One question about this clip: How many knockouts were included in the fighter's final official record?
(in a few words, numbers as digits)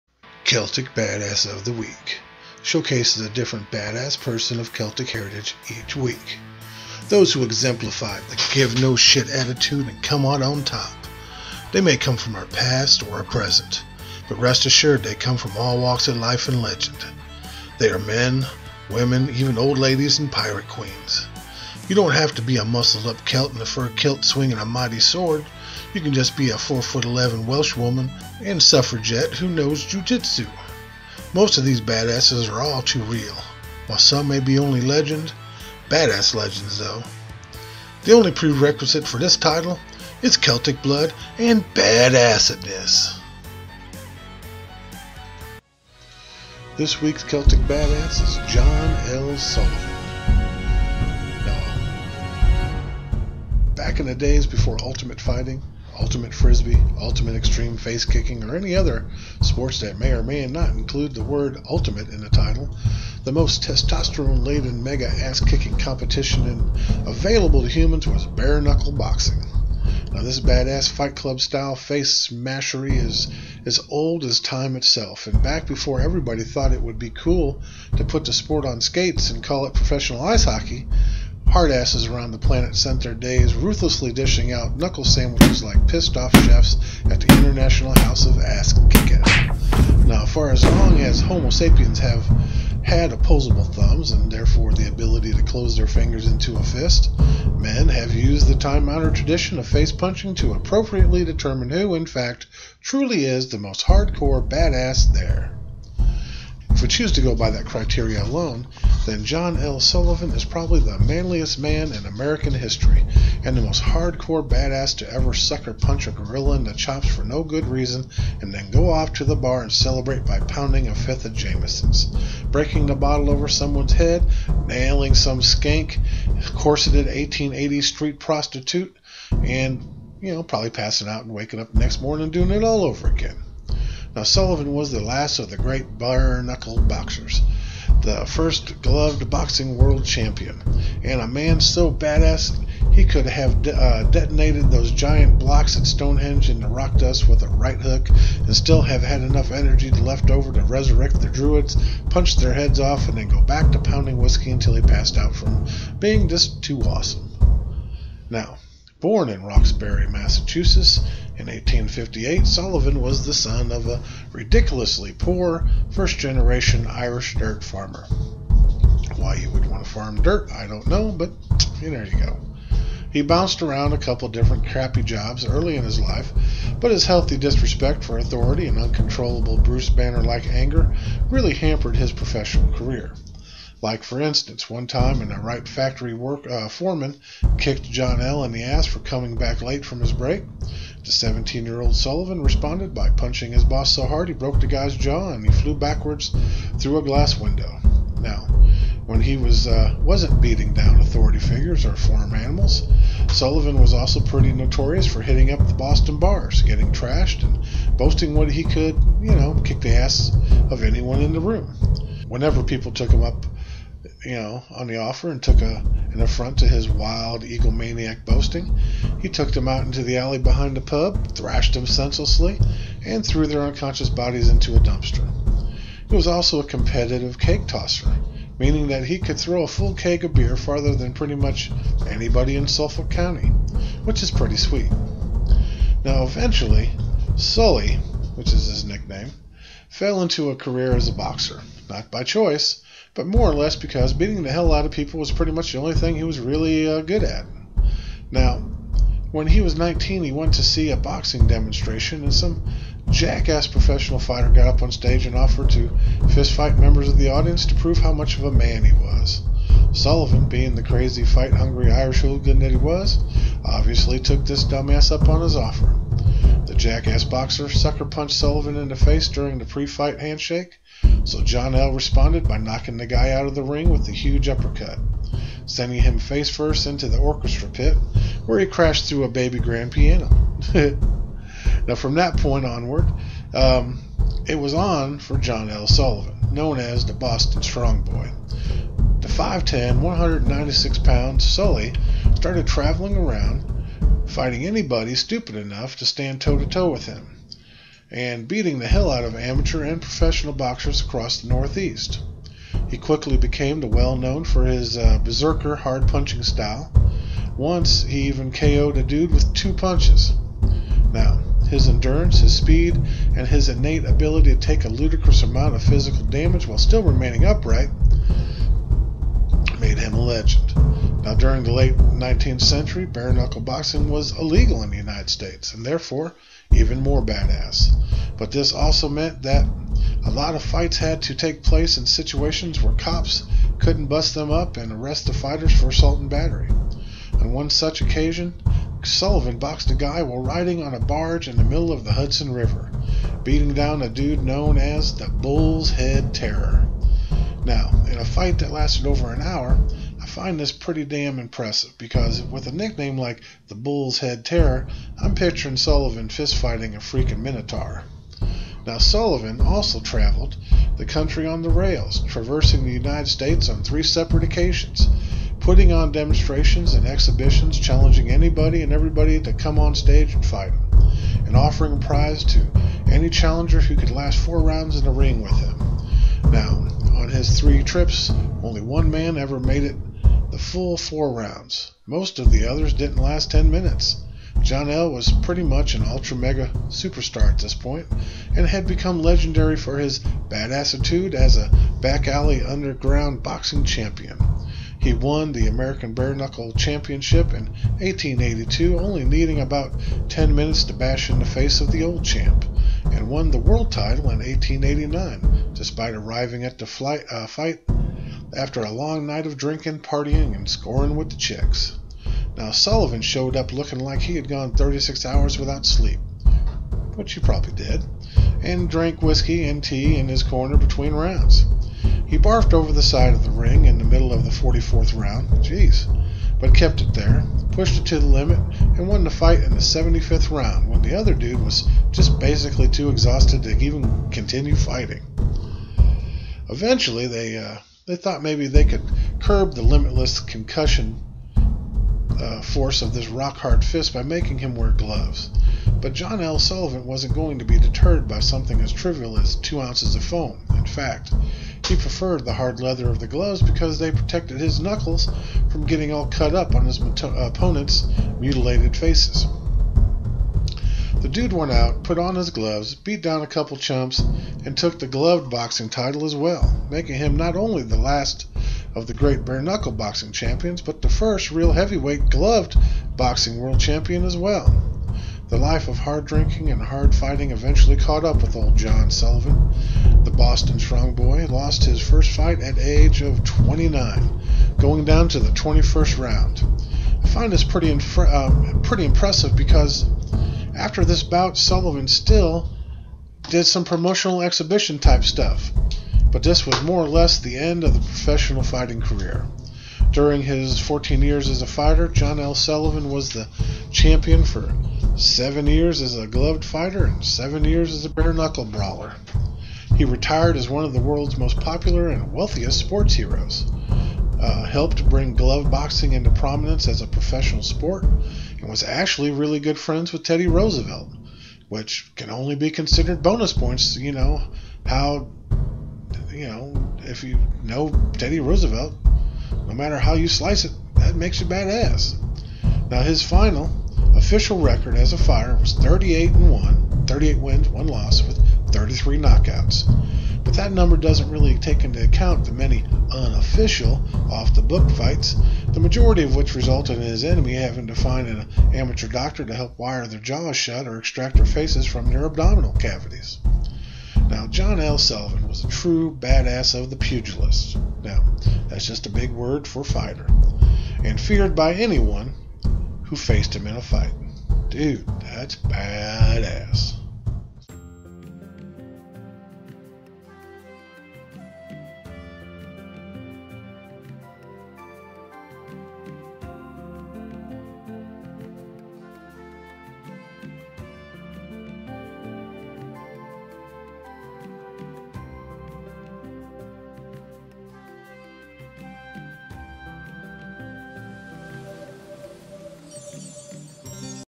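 33.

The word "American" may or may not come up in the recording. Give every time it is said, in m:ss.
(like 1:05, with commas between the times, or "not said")
1:52, 6:35.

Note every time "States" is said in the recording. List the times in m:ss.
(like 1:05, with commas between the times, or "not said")
5:25, 6:03.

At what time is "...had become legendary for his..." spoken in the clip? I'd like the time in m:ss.
6:28.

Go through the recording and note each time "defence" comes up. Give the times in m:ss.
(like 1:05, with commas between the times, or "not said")
not said.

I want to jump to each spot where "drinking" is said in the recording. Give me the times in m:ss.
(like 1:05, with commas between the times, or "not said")
6:49, 7:56.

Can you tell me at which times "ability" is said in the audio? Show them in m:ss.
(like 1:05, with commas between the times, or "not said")
1:34, 5:14.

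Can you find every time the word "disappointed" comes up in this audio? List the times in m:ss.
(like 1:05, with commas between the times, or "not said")
not said.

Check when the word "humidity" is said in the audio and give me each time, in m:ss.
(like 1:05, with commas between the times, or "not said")
not said.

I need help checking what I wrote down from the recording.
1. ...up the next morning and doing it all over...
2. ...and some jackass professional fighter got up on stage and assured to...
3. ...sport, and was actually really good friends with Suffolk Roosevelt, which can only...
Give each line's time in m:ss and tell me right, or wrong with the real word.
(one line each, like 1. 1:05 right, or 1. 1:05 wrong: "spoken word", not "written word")
1. 2:11 right
2. 4:12 wrong: "offered", not "assured"
3. 8:37 wrong: "Teddy", not "Suffolk".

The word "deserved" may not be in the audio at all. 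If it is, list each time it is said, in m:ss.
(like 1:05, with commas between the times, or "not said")
not said.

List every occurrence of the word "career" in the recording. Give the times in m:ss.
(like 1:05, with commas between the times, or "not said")
3:02, 4:00, 8:19.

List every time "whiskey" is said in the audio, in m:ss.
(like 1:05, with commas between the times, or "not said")
2:34, 6:59.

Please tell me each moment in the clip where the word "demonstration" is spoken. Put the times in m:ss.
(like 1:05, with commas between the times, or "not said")
4:11, 6:06.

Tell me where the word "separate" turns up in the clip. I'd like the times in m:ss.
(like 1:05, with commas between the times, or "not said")
6:04.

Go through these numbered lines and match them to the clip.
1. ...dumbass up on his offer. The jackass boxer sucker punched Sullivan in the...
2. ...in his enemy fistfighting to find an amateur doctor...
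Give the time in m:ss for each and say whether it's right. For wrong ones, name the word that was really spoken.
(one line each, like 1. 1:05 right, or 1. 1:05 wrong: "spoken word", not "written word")
1. 4:24 right
2. 9:06 wrong: "having", not "fistfighting".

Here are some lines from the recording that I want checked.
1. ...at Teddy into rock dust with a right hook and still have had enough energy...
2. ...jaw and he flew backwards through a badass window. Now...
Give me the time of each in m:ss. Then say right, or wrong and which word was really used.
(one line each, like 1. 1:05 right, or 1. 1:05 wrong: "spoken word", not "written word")
1. 2:25 wrong: "Stonehenge", not "Teddy"
2. 3:14 wrong: "glass", not "badass".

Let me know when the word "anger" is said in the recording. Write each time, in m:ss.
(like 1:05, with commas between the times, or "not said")
3:00.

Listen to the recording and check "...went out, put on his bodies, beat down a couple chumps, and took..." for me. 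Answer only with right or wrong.
wrong.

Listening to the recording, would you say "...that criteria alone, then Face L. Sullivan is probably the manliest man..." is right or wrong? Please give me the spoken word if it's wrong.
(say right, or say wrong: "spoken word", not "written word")
wrong: "John", not "Face".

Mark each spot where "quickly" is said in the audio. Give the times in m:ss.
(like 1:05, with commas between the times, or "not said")
5:02.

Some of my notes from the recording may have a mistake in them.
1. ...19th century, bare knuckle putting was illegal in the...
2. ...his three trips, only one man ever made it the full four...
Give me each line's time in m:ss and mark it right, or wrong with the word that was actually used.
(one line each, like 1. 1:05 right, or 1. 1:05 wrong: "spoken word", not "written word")
1. 5:21 wrong: "boxing", not "putting"
2. 6:17 right.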